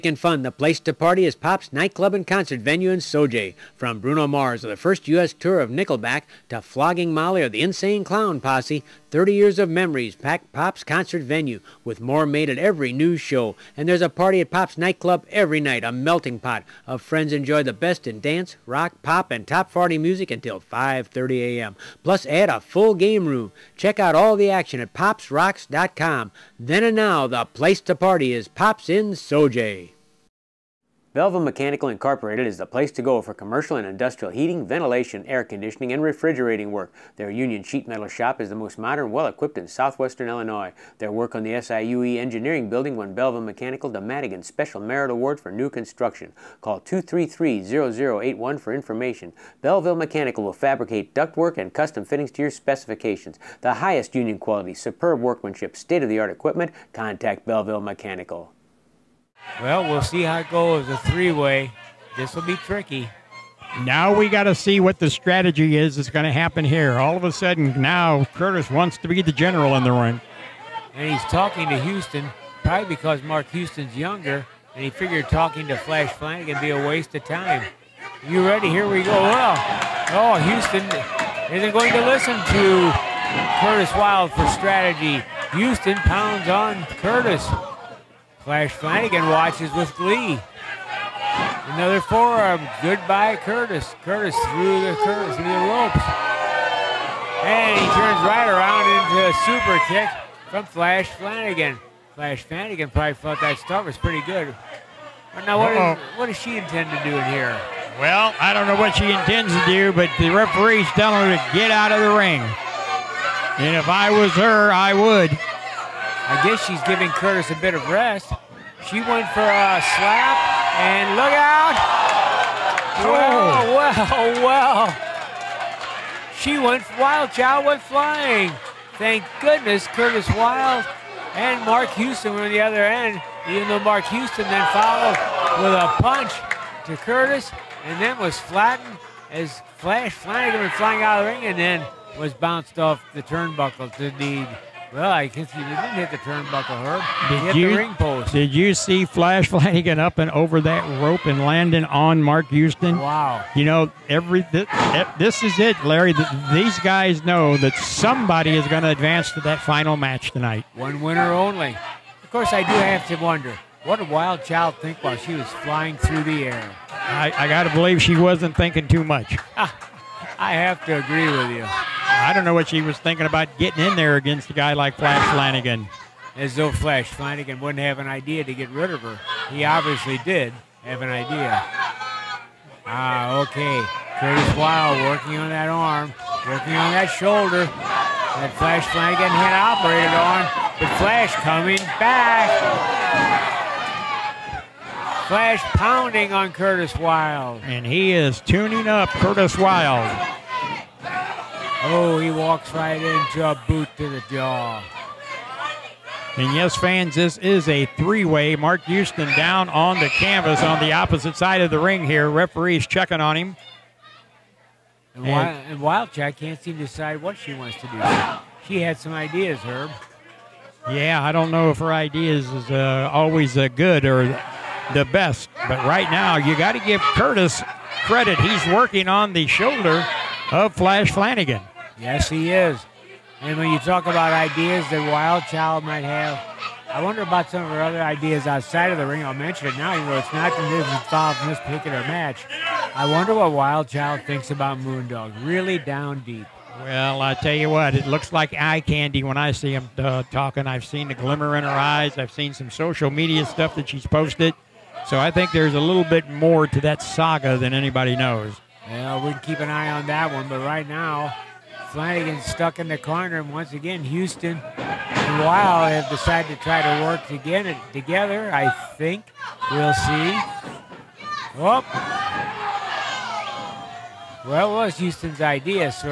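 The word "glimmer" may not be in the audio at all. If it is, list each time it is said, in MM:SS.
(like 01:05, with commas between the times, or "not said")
04:11.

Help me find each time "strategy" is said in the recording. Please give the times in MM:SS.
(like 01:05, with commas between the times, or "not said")
01:05, 01:24.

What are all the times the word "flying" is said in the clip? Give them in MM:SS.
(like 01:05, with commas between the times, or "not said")
02:07, 02:20, 02:45.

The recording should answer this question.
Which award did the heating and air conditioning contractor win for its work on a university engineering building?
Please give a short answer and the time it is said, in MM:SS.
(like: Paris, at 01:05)
Madigan Special Merit Award, at 00:44.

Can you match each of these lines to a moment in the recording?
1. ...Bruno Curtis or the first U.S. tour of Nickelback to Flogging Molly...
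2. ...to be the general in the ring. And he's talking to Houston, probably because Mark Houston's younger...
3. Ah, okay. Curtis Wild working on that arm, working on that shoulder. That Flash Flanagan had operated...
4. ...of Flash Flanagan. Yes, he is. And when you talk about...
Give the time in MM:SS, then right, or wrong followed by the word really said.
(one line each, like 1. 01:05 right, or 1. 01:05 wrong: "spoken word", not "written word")
1. 00:03 wrong: "Mars", not "Curtis"
2. 01:08 right
3. 03:02 right
4. 03:50 right.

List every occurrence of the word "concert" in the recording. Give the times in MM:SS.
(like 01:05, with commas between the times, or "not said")
00:02, 00:10.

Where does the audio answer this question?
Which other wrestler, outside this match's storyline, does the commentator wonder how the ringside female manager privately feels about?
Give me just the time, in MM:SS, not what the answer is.
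04:04.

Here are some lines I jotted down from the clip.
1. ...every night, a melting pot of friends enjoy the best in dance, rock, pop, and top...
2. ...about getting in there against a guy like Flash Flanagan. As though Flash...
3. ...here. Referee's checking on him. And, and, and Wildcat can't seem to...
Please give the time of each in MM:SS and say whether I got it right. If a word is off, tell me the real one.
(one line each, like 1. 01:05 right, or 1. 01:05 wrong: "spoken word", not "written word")
1. 00:15 right
2. 02:53 right
3. 03:32 right.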